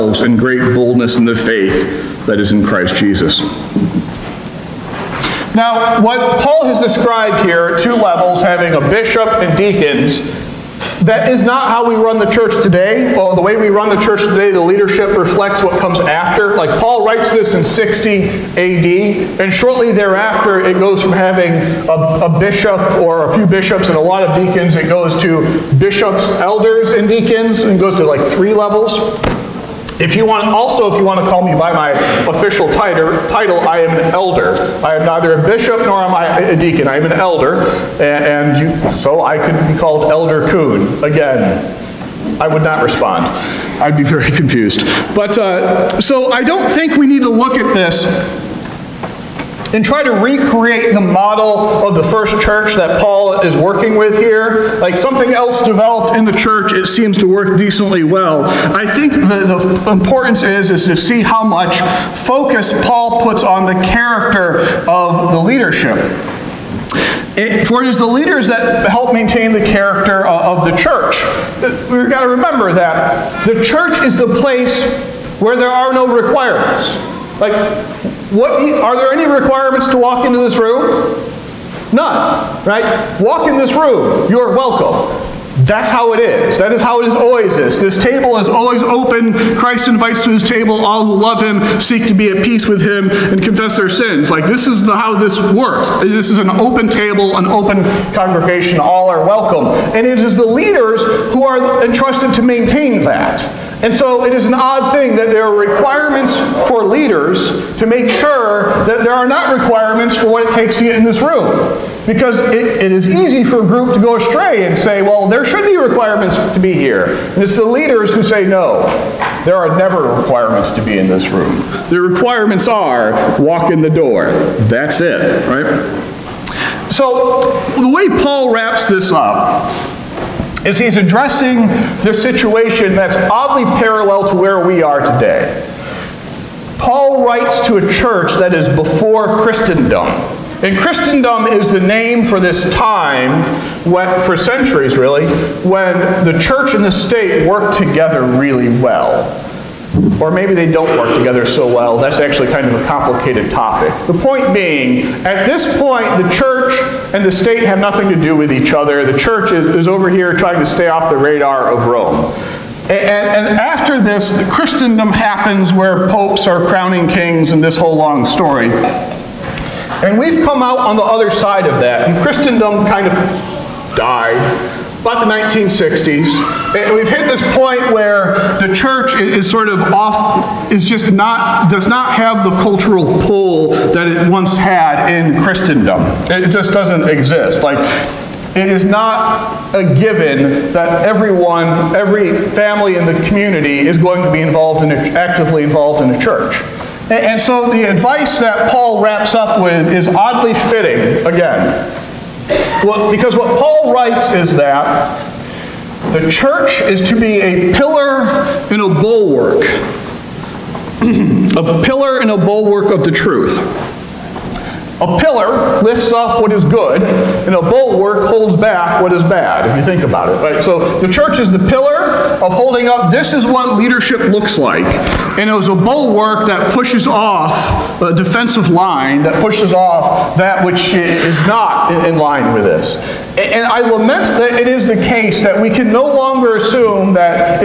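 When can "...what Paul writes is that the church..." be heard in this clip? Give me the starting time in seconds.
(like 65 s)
203 s.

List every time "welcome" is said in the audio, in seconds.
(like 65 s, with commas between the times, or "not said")
84 s, 99 s.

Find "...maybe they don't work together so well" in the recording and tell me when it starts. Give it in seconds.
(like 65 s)
150 s.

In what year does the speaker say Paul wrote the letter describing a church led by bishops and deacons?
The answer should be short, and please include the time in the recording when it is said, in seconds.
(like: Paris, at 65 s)
60 AD, at 17 s.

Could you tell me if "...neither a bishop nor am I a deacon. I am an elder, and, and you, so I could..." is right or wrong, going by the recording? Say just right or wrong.
right.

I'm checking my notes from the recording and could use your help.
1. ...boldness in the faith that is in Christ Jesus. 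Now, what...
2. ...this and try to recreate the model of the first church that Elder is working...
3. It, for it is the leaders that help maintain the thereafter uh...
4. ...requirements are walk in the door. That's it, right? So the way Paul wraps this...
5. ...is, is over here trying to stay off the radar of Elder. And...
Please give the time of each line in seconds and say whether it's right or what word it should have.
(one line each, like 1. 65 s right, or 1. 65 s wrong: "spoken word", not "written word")
1. 0 s right
2. 47 s wrong: "Paul", not "Elder"
3. 67 s wrong: "character", not "thereafter"
4. 121 s right
5. 159 s wrong: "Rome", not "Elder".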